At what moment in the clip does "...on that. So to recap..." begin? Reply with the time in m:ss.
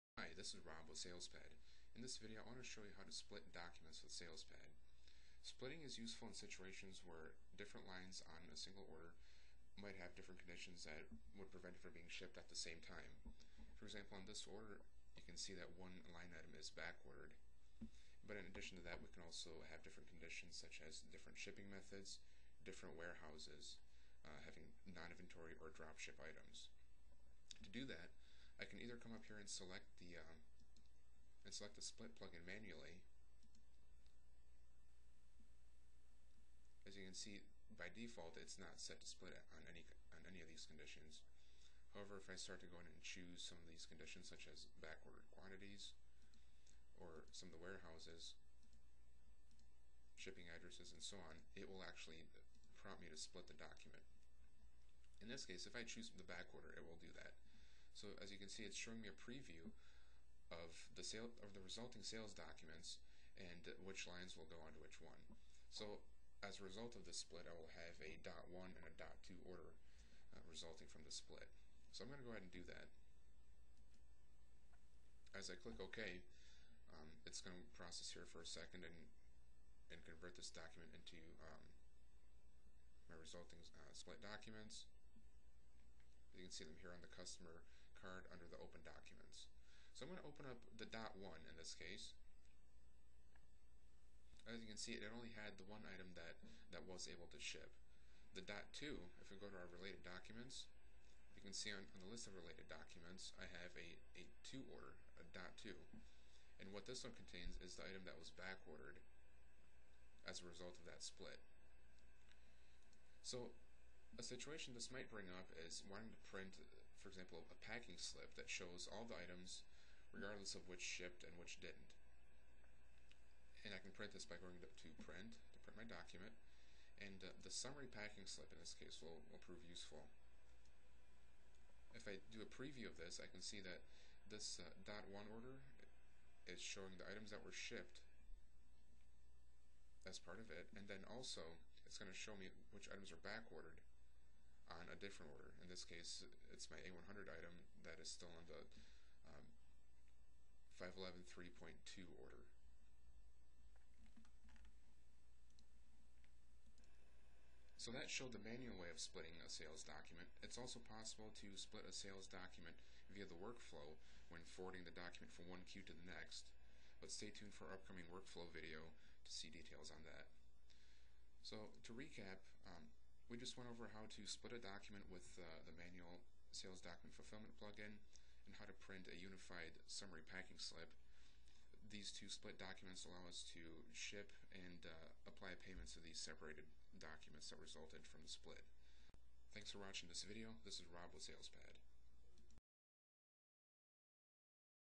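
2:49.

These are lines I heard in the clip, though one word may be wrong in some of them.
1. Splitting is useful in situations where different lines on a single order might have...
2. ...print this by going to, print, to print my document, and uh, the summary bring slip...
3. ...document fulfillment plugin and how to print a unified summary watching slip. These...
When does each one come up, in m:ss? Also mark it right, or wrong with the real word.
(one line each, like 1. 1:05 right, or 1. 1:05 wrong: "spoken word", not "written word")
1. 0:05 right
2. 2:03 wrong: "packing", not "bring"
3. 2:56 wrong: "packing", not "watching".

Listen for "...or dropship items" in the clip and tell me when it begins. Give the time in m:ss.
0:25.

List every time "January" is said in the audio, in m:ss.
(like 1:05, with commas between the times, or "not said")
not said.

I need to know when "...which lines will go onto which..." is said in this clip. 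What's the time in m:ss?
1:03.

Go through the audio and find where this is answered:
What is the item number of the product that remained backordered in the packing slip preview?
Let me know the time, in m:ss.
2:26.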